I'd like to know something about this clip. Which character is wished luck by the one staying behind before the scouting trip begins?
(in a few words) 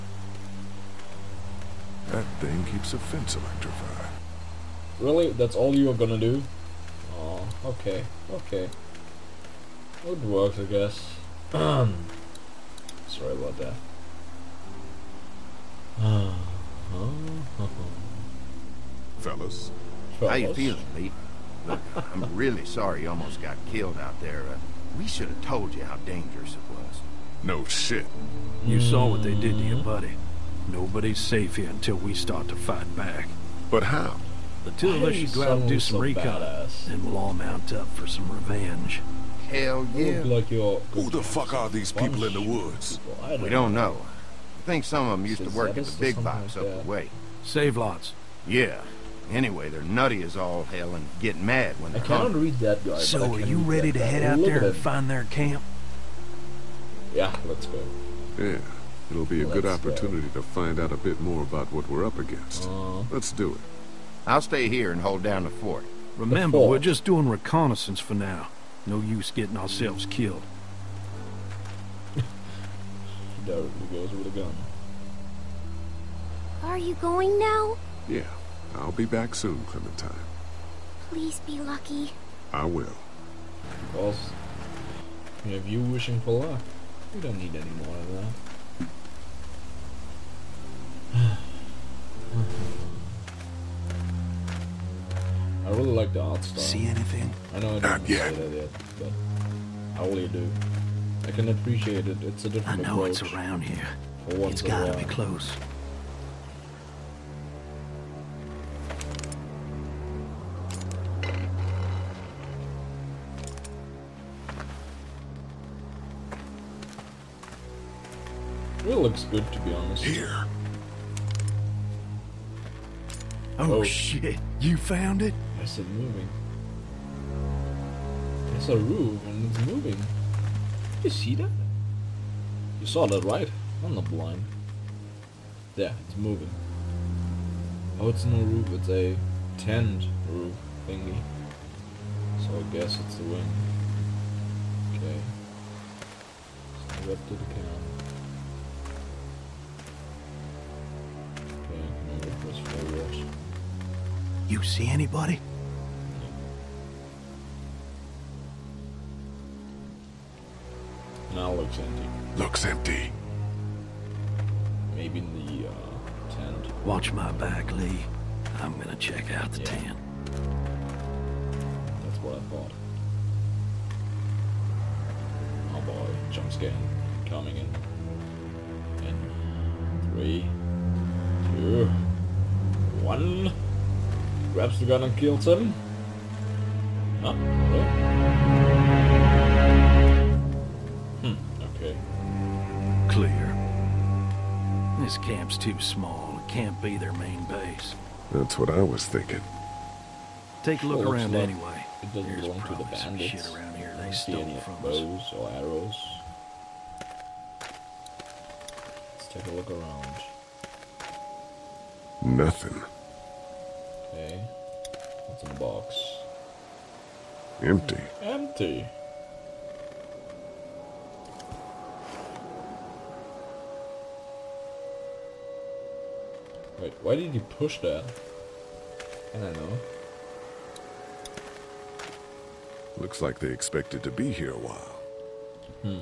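Clementine.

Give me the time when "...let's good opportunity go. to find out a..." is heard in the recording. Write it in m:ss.
0:59.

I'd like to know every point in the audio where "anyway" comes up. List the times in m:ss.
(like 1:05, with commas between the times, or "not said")
0:49, 3:21.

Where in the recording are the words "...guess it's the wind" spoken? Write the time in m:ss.
2:22.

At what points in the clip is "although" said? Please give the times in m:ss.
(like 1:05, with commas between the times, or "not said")
not said.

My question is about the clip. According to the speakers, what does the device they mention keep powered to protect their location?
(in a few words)
The fence.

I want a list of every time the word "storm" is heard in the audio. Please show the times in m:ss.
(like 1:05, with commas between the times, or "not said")
not said.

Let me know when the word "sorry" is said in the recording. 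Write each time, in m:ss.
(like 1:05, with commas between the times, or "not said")
0:11, 0:22.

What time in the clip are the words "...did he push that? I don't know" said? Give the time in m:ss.
3:47.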